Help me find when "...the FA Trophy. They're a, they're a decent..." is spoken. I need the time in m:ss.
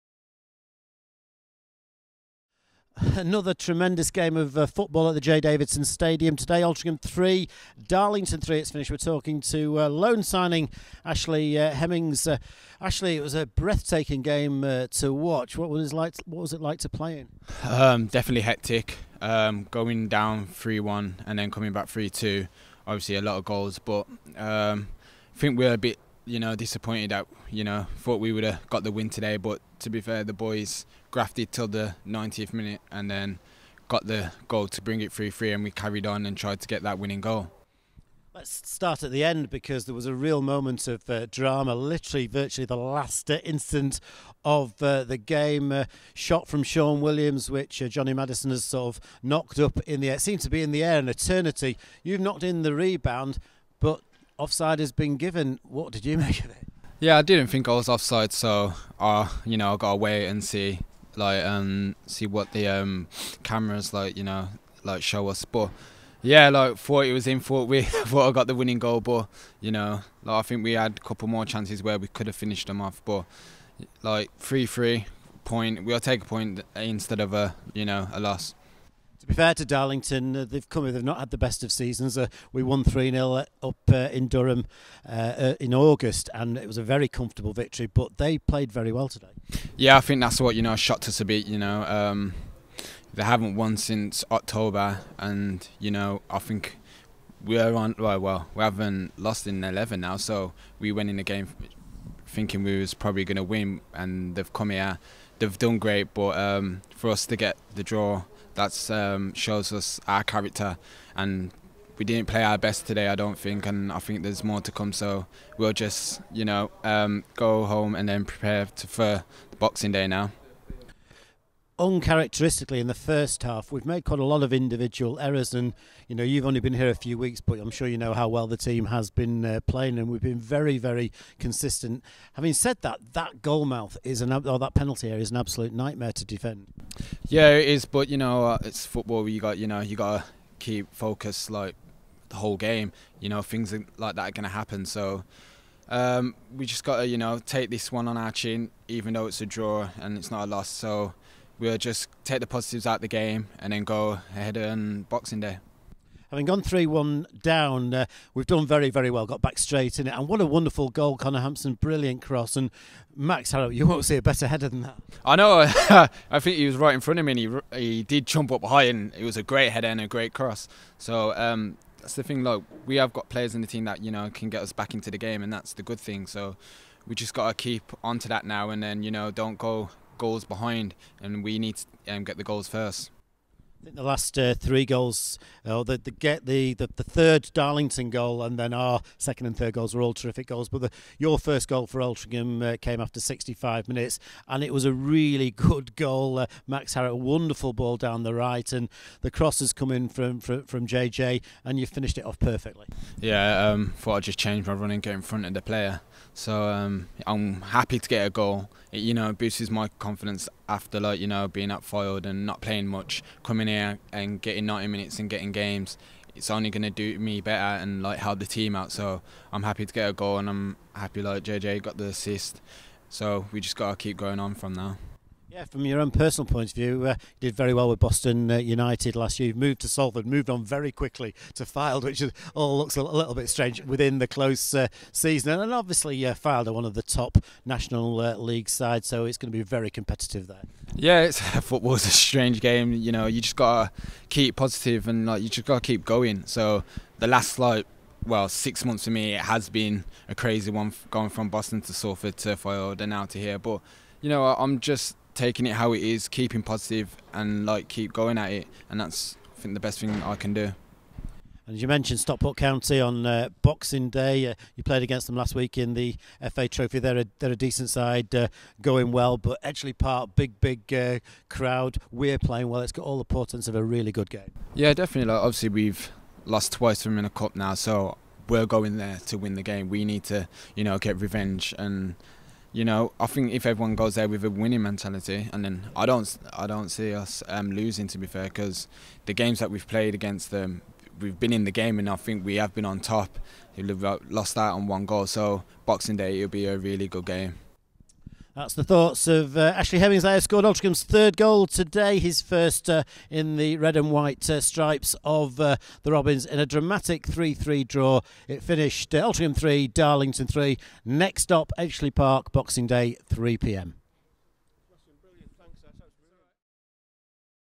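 4:25.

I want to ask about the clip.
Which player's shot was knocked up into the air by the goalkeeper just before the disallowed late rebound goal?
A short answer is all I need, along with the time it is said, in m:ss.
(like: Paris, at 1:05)
Sean Williams, at 0:46.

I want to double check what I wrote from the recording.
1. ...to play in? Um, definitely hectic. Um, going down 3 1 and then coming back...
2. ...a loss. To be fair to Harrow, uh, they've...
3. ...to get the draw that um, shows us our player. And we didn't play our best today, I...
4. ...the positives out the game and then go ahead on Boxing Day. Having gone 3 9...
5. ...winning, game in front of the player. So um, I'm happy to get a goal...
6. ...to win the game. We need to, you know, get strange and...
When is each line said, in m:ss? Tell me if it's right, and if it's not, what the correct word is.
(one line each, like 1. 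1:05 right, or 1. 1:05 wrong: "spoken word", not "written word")
1. 0:16 right
2. 1:18 wrong: "Darlington", not "Harrow"
3. 1:47 wrong: "character", not "player"
4. 2:32 wrong: "1", not "9"
5. 3:24 wrong: "running", not "winning"
6. 4:39 wrong: "revenge", not "strange".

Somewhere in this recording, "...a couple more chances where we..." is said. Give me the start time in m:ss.
1:11.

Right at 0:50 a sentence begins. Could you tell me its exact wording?
It seemed to be in the air an eternity.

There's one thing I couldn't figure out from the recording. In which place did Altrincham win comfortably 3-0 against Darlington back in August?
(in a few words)
Durham.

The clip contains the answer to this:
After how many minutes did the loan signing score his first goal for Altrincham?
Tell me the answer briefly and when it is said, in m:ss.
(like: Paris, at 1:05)
65, at 3:13.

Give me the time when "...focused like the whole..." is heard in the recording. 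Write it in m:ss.
2:20.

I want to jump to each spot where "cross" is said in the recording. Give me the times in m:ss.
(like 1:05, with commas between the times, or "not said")
2:42, 2:50, 3:19.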